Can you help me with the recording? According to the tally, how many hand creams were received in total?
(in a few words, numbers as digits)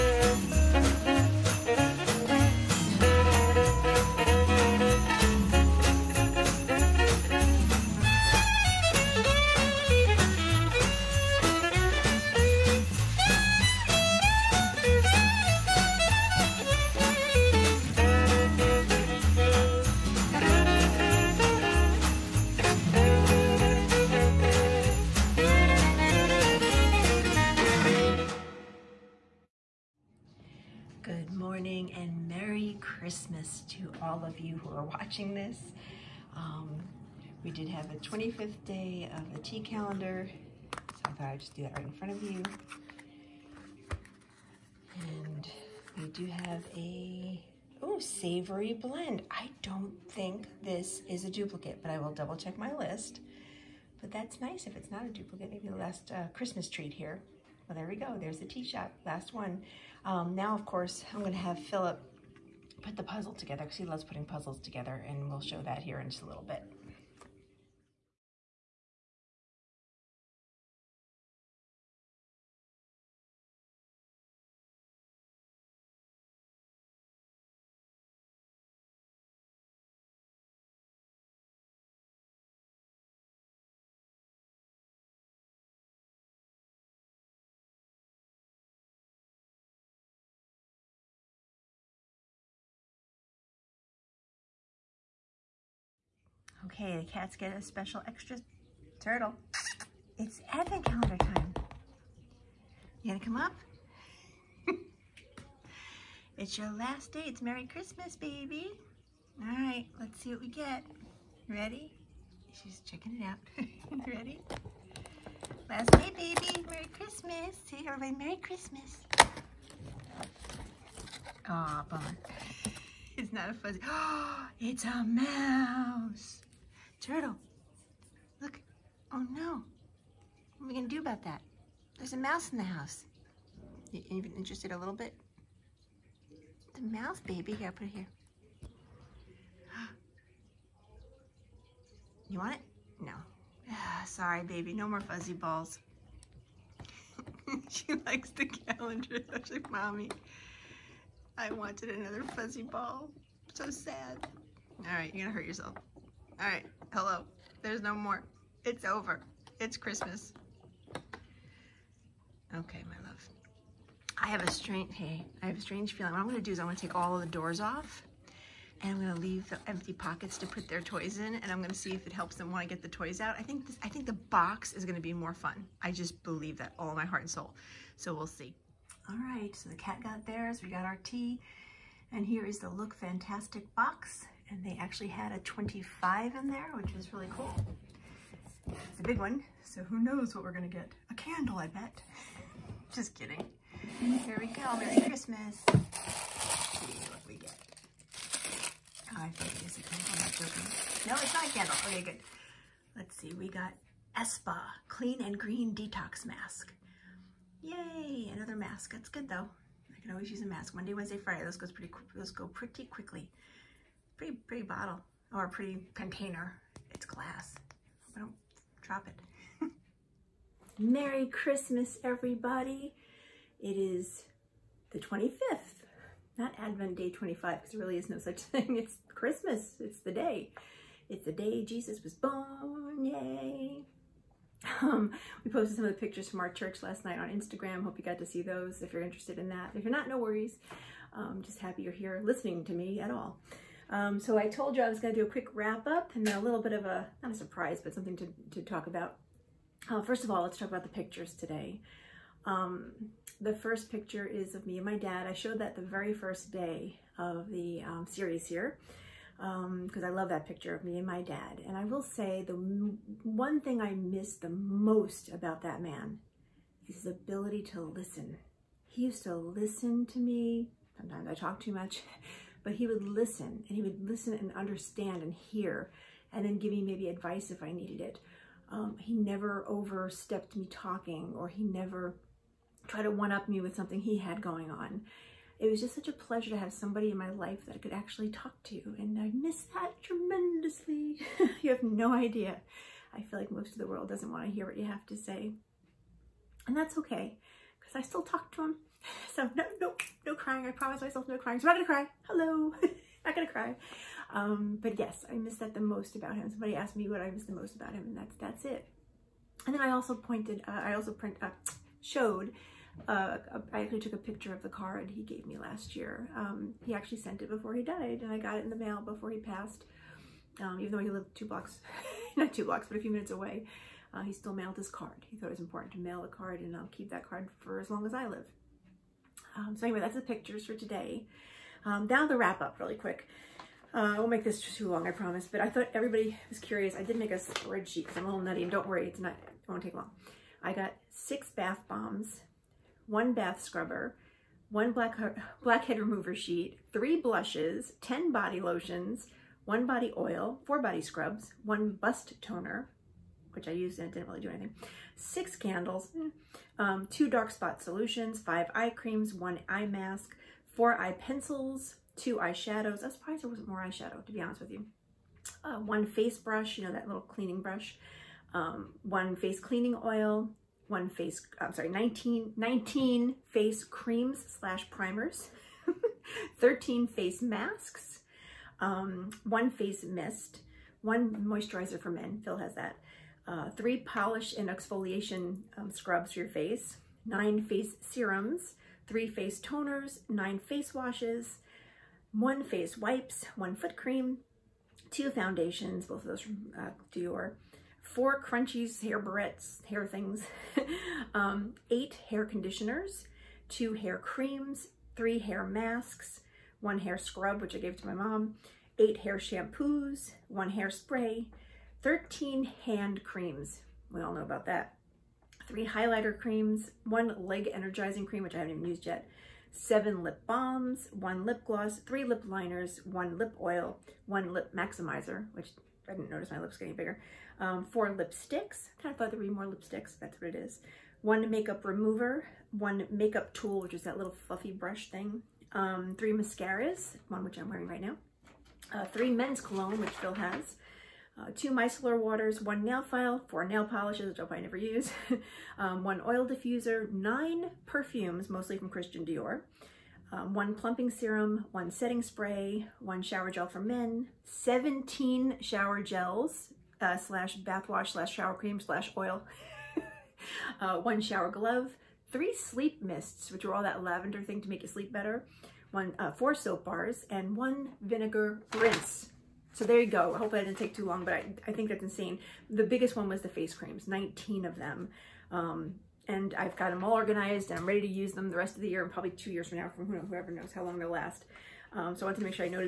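13.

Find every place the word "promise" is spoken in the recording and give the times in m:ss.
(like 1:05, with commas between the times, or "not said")
5:00, 5:35.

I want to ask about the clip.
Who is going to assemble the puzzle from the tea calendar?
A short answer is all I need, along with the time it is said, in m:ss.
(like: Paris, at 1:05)
Philip, at 1:01.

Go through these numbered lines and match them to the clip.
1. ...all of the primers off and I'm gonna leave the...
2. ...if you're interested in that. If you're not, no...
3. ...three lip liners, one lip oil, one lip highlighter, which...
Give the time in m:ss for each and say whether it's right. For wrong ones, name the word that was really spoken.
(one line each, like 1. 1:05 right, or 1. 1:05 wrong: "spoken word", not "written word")
1. 2:46 wrong: "doors", not "primers"
2. 3:58 right
3. 7:02 wrong: "maximizer", not "highlighter".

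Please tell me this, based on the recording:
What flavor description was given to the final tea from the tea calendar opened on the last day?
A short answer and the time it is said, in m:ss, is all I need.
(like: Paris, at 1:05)
Savory blend, at 0:47.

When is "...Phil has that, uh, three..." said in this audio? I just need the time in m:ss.
6:22.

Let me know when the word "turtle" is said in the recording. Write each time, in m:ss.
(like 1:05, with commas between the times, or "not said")
1:39, 2:07.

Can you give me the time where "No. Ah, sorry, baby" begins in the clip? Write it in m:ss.
2:23.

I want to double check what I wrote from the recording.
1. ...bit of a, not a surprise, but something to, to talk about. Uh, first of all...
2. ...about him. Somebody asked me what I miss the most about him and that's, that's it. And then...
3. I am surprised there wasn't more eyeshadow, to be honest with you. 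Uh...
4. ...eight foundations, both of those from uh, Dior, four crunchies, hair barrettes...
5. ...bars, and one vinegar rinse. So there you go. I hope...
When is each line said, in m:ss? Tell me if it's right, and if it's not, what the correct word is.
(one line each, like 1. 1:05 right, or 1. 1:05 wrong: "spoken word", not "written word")
1. 4:06 right
2. 5:06 right
3. 6:03 right
4. 6:35 wrong: "two", not "eight"
5. 7:46 right.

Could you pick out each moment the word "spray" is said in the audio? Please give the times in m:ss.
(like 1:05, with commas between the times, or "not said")
6:50, 7:32.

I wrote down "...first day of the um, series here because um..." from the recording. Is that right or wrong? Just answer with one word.
right.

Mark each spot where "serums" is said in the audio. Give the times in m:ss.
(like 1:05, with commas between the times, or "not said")
6:28, 7:31.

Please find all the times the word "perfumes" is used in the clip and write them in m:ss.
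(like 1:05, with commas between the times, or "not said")
7:27.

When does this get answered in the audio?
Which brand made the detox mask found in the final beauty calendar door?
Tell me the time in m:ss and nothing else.
3:24.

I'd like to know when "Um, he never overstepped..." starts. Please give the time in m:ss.
4:38.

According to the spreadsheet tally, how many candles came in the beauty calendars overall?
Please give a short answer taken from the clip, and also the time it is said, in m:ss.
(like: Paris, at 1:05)
6, at 5:55.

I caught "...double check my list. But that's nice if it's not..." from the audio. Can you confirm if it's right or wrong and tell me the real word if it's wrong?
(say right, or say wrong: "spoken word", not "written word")
right.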